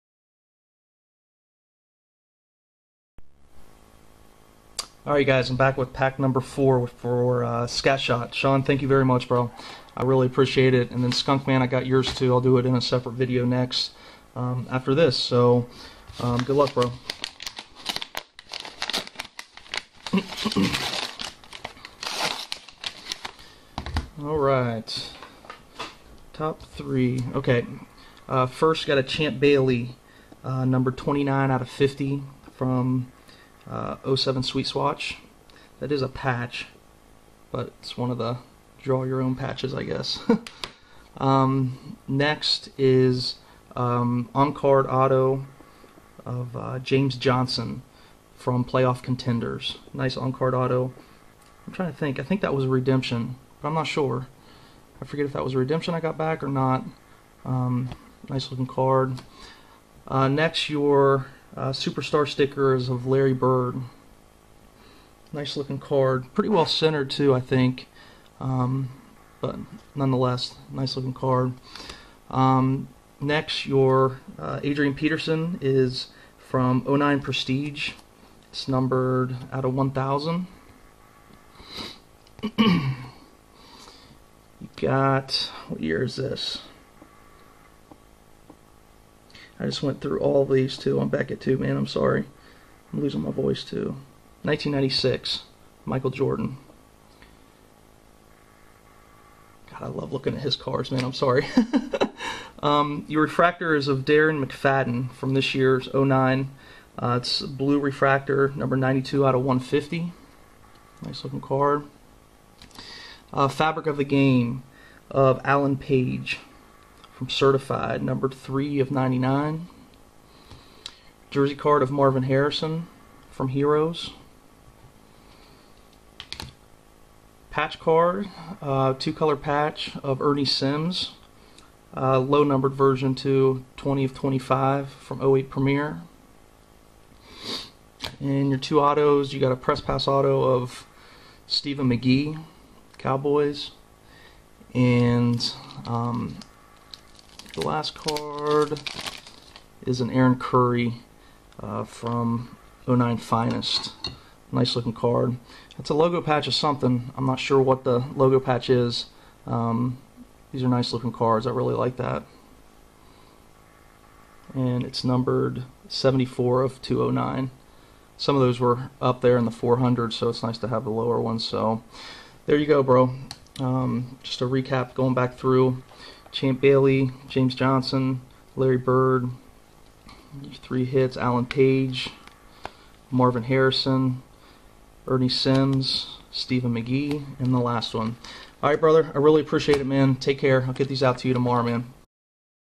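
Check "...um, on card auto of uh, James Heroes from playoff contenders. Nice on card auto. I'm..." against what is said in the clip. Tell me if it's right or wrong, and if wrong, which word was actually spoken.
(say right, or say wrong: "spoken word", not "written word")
wrong: "Johnson", not "Heroes".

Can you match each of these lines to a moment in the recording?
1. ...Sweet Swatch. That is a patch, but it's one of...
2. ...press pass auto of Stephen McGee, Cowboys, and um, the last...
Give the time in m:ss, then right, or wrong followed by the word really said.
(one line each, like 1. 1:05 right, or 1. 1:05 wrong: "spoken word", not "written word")
1. 0:34 right
2. 2:19 right.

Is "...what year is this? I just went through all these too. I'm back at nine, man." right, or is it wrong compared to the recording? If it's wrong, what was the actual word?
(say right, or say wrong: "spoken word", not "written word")
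wrong: "two", not "nine".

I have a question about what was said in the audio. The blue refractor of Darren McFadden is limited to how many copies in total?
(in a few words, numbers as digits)
150.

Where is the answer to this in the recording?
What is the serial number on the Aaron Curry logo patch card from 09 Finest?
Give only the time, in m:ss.
2:45.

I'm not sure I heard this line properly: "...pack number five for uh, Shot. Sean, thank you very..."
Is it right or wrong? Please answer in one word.
wrong.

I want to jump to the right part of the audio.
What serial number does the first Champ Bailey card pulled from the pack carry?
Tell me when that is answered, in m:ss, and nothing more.
0:30.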